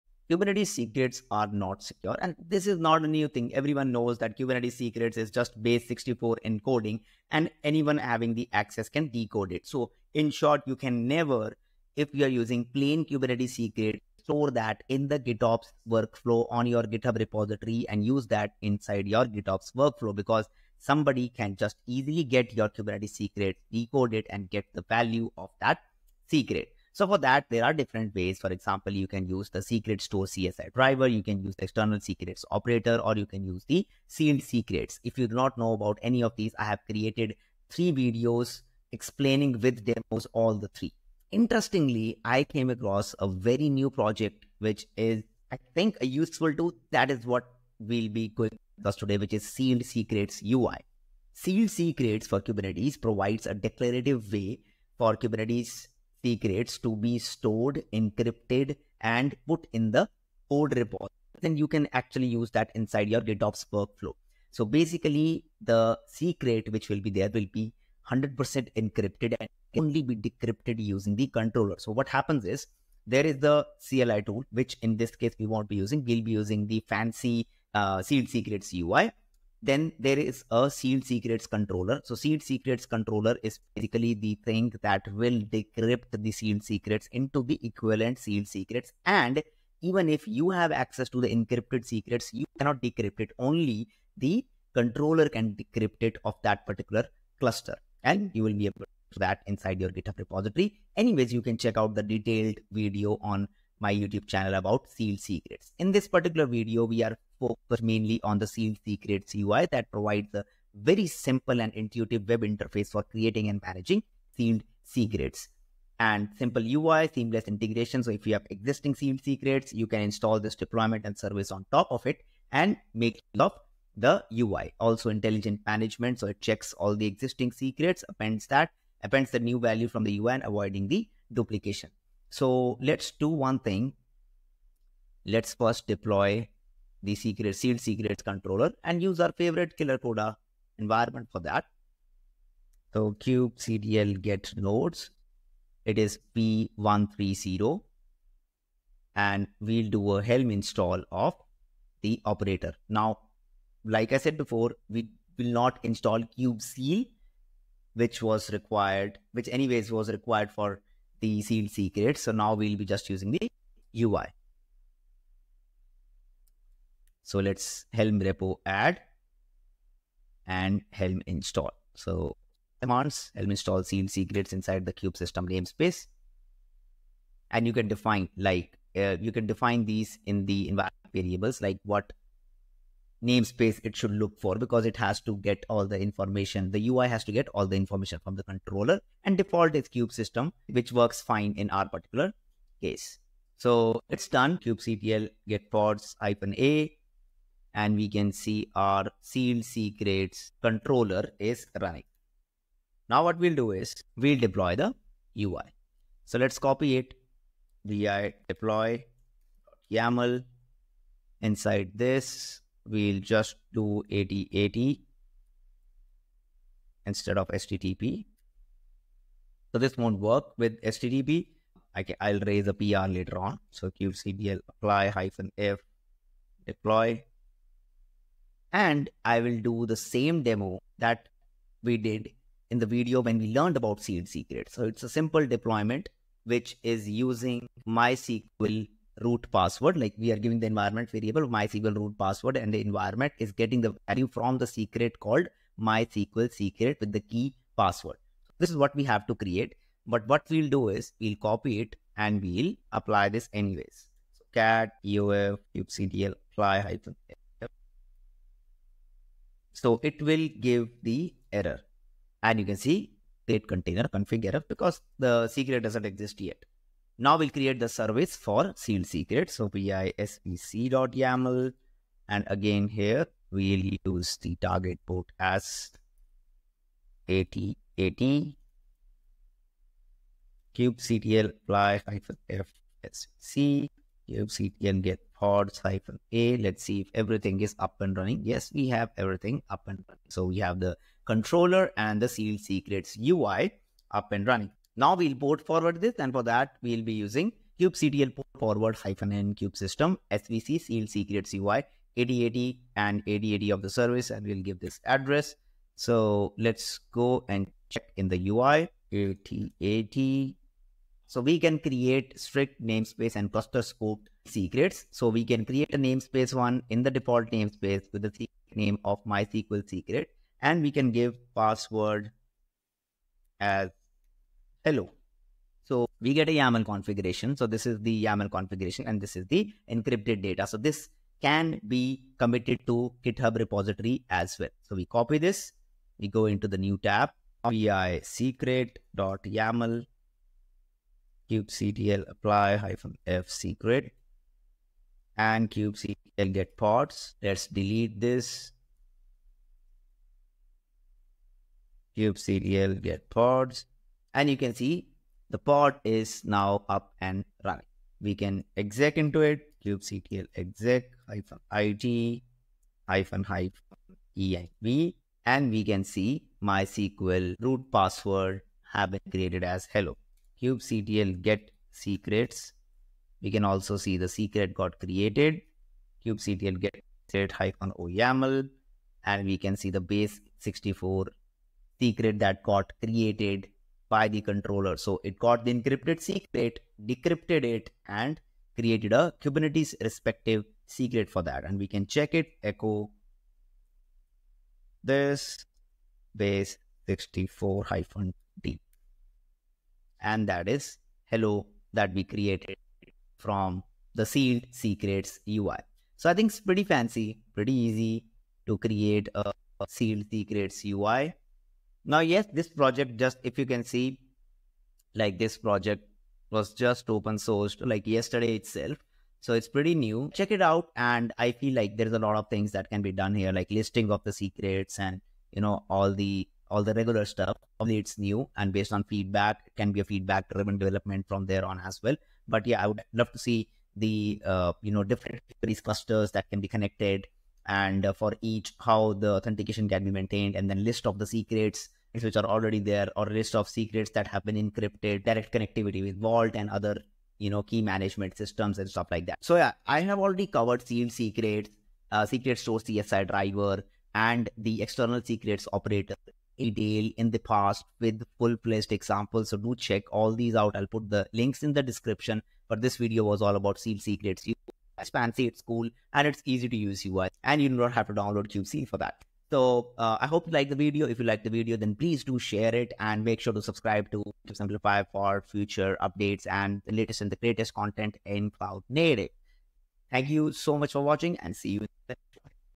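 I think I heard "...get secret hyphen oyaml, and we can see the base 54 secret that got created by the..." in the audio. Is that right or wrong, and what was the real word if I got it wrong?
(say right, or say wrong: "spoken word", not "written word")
wrong: "64", not "54".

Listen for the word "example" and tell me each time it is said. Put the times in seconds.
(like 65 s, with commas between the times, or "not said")
28 s, 458 s.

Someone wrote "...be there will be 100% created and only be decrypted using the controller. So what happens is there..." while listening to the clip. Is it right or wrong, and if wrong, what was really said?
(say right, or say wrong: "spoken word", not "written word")
wrong: "encrypted", not "created".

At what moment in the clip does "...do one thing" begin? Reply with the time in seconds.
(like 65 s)
133 s.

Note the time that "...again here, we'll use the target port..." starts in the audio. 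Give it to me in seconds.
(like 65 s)
272 s.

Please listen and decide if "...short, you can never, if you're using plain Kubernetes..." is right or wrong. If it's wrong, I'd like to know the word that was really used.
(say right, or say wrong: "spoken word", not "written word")
right.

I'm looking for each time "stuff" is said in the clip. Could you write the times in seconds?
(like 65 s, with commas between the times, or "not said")
427 s, 448 s.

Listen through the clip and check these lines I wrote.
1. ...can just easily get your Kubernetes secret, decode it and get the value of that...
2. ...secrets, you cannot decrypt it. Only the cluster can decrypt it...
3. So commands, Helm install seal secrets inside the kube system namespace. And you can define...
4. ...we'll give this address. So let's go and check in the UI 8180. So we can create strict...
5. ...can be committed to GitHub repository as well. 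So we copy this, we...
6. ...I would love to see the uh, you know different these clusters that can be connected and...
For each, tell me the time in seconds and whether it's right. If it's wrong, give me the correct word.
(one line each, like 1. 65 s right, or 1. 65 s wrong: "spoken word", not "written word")
1. 21 s right
2. 91 s wrong: "controller", not "cluster"
3. 171 s right
4. 304 s wrong: "8080", not "8180"
5. 331 s right
6. 432 s right.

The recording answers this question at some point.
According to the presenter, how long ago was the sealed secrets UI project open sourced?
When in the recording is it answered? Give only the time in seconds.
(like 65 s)
418 s.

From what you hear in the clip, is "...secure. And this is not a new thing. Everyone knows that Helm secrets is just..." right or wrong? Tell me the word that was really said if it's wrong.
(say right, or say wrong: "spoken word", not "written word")
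wrong: "Kubernetes", not "Helm".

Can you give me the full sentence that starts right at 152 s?
Now, like I said before, we will not install c, which was required, which anyways was required for the sealed secrets.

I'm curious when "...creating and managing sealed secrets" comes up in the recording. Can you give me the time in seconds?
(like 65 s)
113 s.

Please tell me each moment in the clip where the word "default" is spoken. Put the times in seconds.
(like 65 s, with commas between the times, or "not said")
189 s, 317 s.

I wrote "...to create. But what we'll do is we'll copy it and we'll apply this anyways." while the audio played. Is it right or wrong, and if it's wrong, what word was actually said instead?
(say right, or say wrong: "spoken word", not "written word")
right.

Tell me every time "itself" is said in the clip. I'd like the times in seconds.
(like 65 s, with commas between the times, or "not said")
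418 s.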